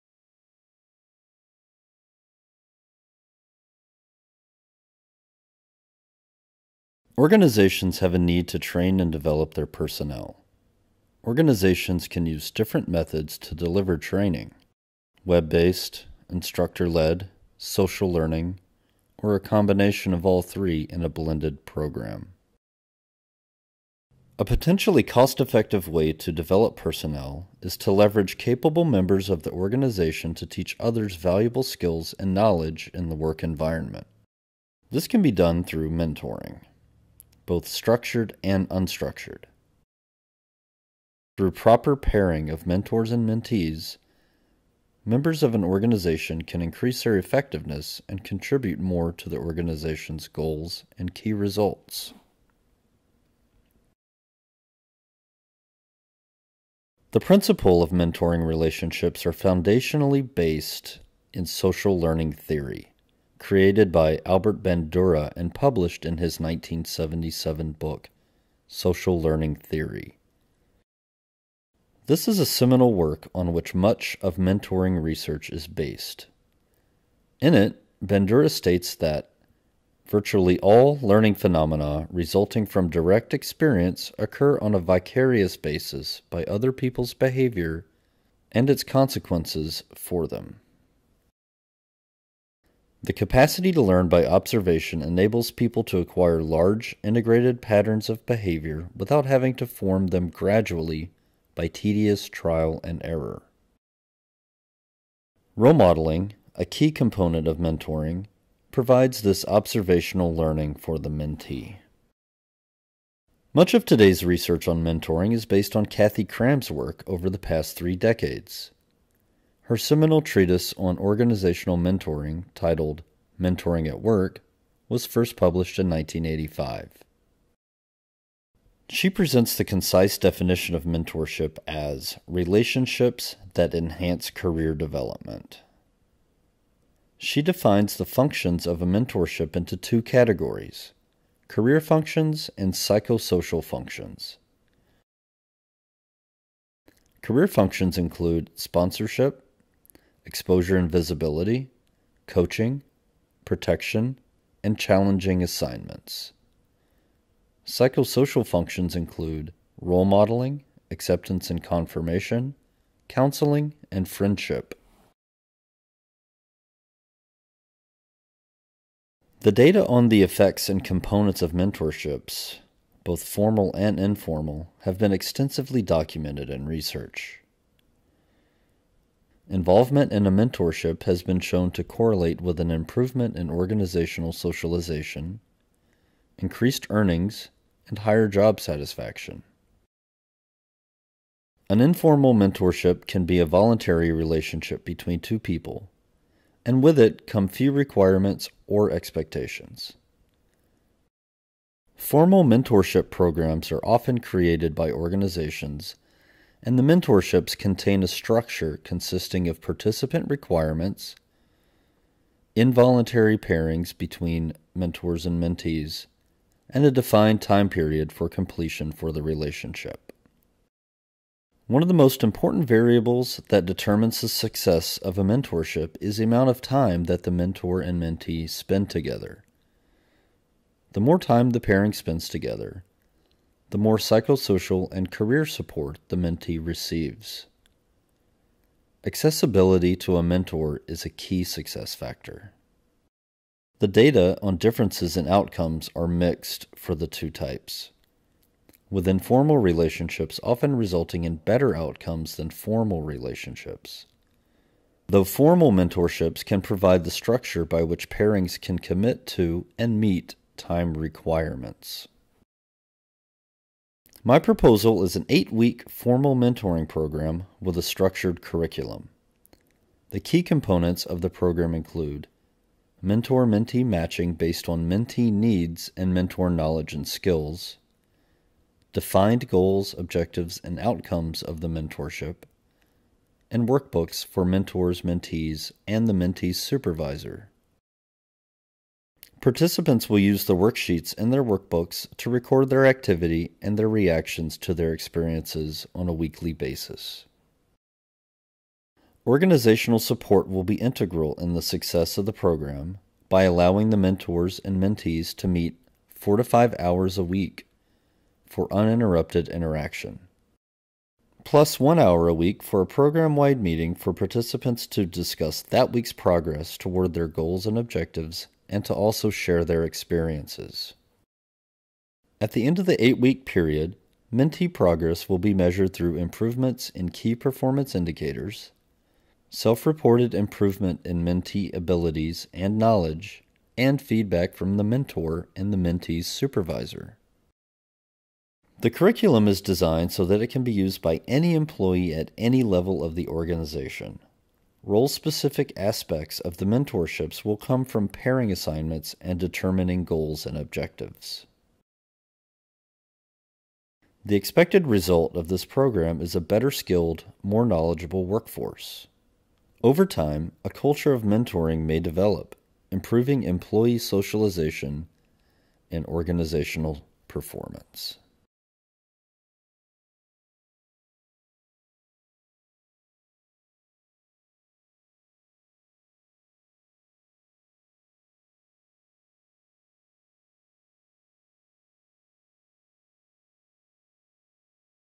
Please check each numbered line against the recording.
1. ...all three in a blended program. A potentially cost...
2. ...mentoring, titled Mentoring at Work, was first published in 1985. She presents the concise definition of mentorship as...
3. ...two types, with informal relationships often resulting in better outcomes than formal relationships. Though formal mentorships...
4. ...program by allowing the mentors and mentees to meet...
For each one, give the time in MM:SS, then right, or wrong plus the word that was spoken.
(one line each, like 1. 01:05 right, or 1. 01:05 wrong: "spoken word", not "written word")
1. 00:20 right
2. 02:01 right
3. 04:07 right
4. 05:02 right.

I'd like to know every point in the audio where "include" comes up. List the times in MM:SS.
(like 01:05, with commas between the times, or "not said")
02:27, 02:38, 04:31.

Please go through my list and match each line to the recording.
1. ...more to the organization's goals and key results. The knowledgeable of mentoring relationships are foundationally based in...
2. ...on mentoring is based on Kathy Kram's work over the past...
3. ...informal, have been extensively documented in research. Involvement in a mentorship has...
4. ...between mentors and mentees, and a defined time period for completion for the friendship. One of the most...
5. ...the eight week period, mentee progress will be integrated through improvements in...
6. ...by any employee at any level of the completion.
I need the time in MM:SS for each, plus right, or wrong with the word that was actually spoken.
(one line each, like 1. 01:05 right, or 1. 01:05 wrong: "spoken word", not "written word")
1. 00:48 wrong: "principle", not "knowledgeable"
2. 01:54 right
3. 02:53 right
4. 03:33 wrong: "relationship", not "friendship"
5. 05:22 wrong: "measured", not "integrated"
6. 05:41 wrong: "organization", not "completion".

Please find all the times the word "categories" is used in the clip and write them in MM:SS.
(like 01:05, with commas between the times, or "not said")
02:20.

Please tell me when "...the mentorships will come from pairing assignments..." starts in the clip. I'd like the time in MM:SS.
05:46.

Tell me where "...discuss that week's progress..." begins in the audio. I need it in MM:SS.
05:15.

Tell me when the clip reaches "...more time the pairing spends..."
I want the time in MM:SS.
03:50.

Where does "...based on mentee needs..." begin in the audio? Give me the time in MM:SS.
04:34.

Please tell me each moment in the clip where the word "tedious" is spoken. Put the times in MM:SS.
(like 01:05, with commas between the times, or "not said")
01:41.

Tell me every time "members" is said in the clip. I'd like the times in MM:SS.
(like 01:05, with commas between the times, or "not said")
00:28, 00:45.